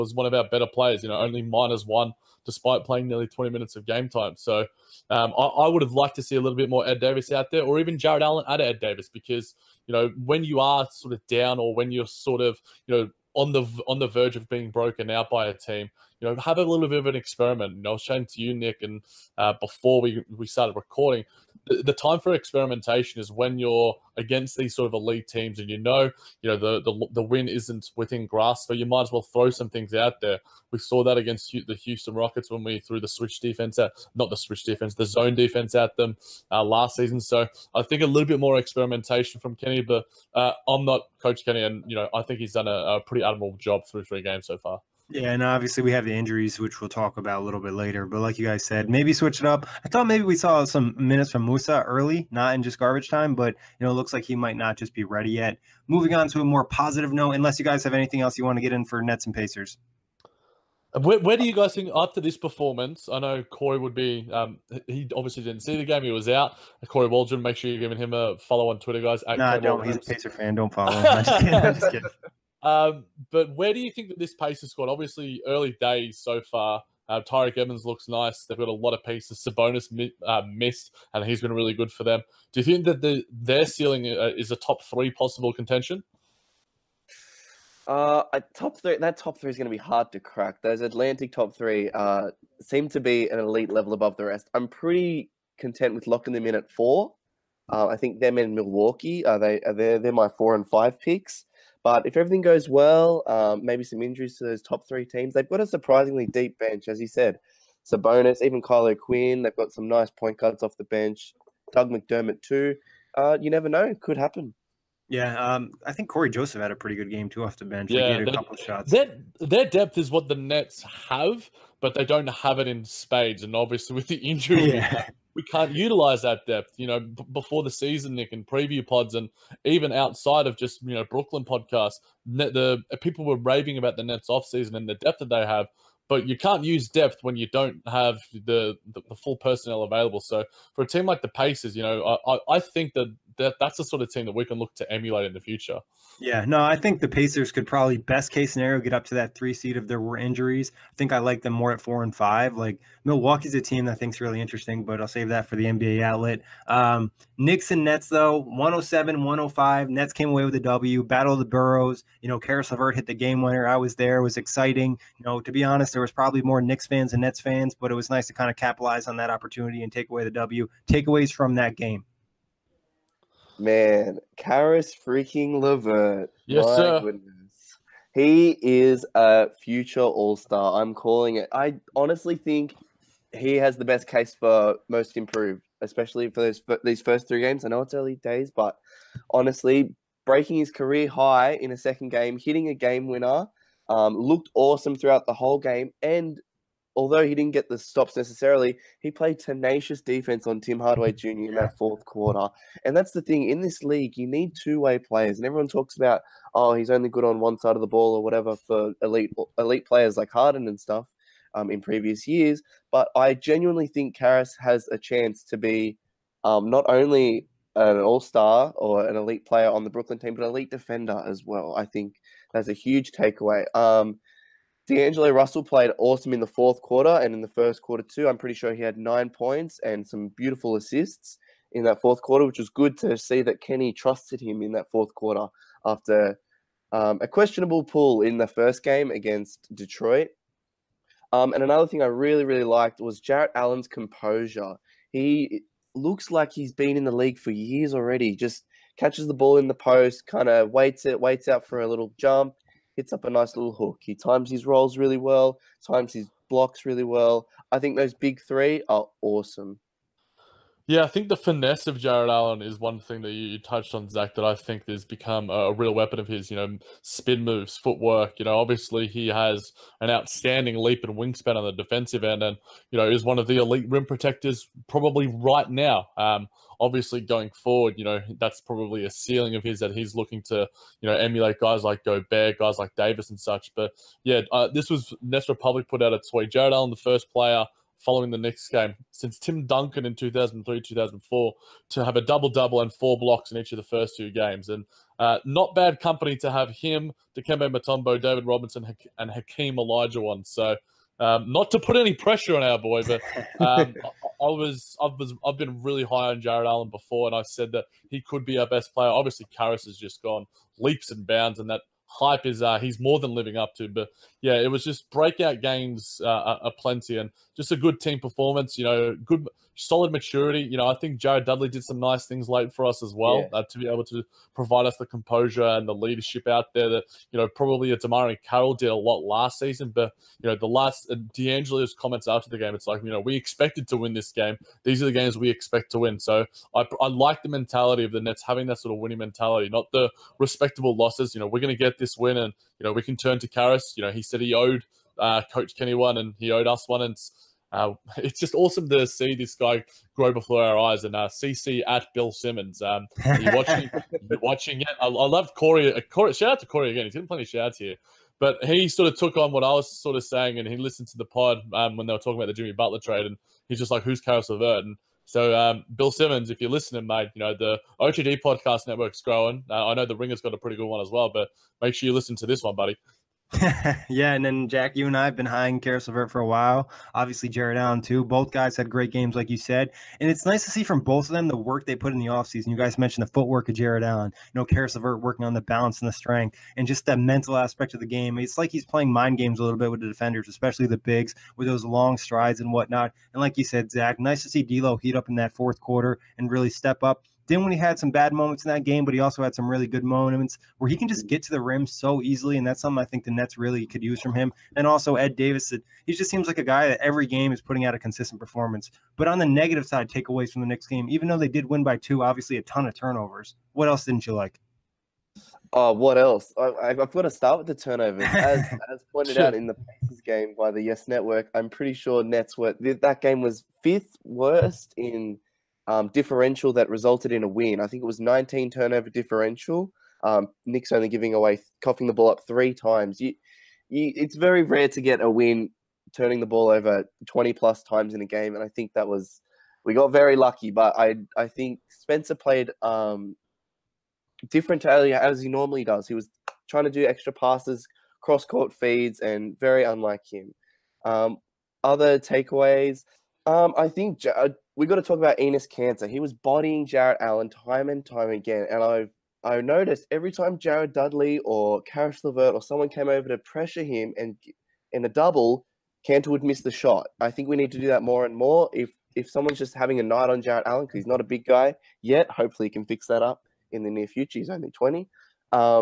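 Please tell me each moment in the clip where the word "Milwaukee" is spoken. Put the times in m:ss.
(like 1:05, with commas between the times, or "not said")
1:38, 2:33.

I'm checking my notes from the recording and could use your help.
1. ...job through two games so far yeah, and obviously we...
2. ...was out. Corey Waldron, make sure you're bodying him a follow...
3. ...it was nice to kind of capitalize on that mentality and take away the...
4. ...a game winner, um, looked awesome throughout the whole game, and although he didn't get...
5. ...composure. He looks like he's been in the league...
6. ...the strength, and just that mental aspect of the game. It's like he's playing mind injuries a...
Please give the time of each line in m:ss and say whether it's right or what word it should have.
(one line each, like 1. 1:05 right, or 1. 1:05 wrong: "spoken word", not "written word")
1. 0:43 wrong: "three", not "two"
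2. 1:06 wrong: "giving", not "bodying"
3. 2:47 wrong: "opportunity", not "mentality"
4. 3:12 right
5. 4:03 right
6. 6:26 wrong: "games", not "injuries".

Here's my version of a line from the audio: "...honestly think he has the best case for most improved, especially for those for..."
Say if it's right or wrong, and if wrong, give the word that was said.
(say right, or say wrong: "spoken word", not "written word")
right.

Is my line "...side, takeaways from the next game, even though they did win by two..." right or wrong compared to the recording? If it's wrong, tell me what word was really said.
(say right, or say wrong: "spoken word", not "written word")
right.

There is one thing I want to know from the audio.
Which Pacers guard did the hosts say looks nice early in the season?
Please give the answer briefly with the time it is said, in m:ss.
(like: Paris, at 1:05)
Tyreek Evans, at 1:17.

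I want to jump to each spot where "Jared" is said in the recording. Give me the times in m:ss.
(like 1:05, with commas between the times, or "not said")
5:21, 7:40.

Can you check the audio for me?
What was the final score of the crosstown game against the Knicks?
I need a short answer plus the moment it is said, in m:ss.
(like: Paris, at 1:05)
107-105, at 2:38.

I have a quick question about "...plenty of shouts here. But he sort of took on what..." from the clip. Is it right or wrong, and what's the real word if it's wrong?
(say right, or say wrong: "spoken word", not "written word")
right.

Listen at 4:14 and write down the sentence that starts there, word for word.
He times his rolls really well, times his blocks really well.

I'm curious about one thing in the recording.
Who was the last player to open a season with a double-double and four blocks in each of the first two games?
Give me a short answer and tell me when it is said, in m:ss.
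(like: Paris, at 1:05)
Tim Duncan, at 4:49.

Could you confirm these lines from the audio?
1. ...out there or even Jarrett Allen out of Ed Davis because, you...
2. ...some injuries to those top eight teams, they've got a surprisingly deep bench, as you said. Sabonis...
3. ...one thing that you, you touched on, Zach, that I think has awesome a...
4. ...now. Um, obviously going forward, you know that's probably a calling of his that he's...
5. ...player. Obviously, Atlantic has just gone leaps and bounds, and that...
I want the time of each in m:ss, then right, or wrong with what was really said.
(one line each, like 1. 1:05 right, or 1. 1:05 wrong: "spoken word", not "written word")
1. 0:07 right
2. 1:43 wrong: "three", not "eight"
3. 4:22 wrong: "become", not "awesome"
4. 4:35 wrong: "ceiling", not "calling"
5. 5:08 wrong: "Caris", not "Atlantic".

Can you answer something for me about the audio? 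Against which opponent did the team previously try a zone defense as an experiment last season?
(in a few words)
Houston Rockets.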